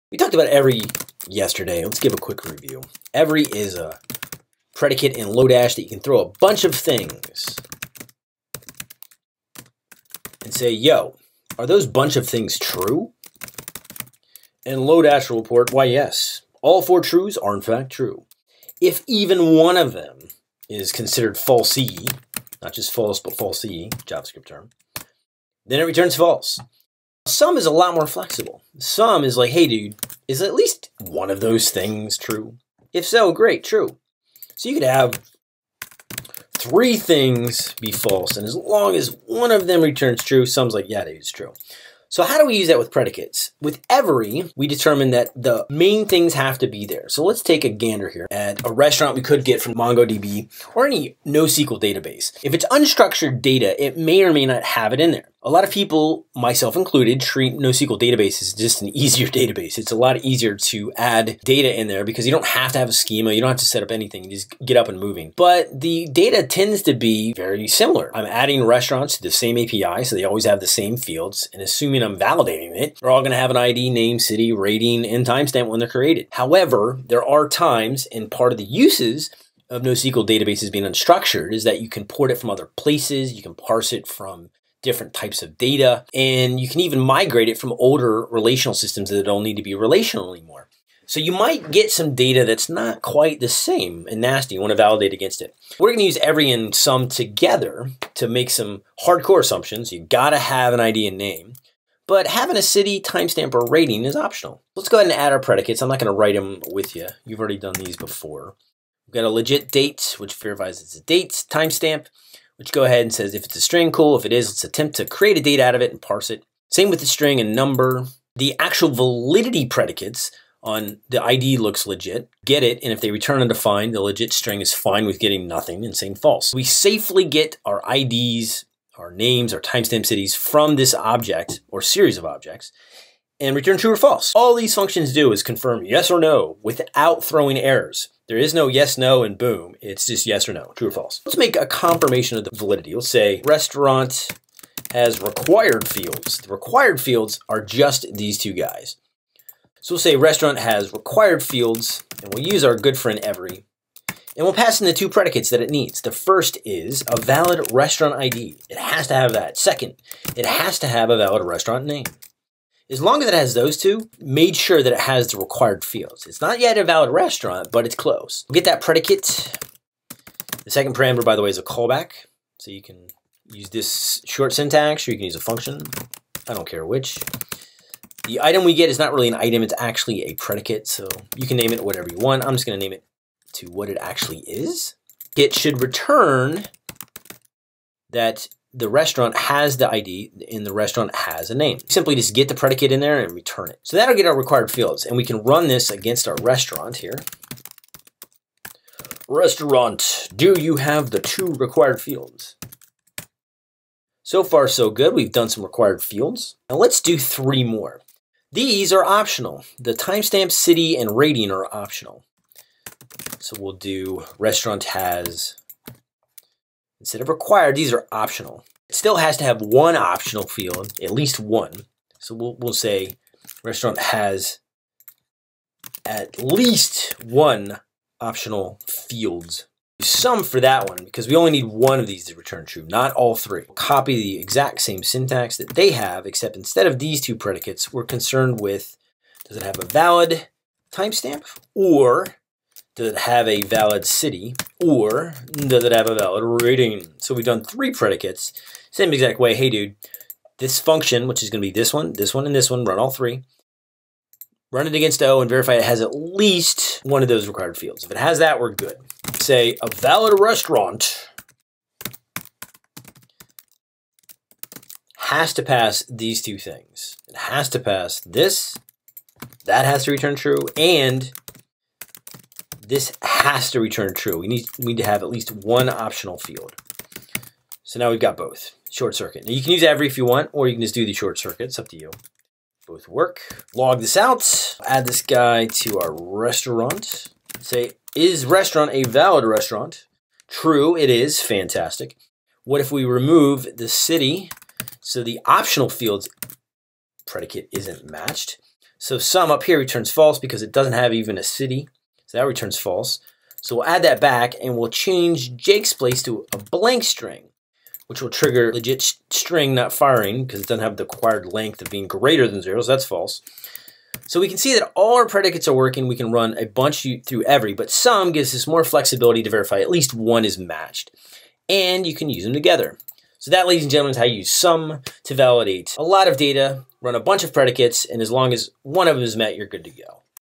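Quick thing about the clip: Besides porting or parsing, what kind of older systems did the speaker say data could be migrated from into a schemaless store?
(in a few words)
relational systems.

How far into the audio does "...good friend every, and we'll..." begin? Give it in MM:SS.
02:32.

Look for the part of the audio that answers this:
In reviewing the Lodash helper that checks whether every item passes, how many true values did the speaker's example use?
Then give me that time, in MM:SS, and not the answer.
00:16.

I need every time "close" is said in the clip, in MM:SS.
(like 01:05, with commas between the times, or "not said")
02:47.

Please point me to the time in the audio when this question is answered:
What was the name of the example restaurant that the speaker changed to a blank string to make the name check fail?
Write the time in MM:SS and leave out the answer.
05:05.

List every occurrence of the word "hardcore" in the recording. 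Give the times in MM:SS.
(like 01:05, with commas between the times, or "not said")
01:39.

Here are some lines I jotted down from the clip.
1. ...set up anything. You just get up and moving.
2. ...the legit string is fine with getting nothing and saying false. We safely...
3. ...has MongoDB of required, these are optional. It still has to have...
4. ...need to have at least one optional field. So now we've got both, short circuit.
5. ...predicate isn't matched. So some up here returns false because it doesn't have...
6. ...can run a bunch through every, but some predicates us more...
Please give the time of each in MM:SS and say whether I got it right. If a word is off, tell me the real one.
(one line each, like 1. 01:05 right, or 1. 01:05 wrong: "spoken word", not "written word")
1. 01:03 right
2. 02:03 right
3. 03:34 wrong: "Instead", not "MongoDB"
4. 04:34 right
5. 04:57 right
6. 05:16 wrong: "gives", not "predicates".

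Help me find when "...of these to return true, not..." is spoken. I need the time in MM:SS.
03:51.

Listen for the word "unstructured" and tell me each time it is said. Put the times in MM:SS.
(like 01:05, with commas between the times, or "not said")
00:52, 01:20.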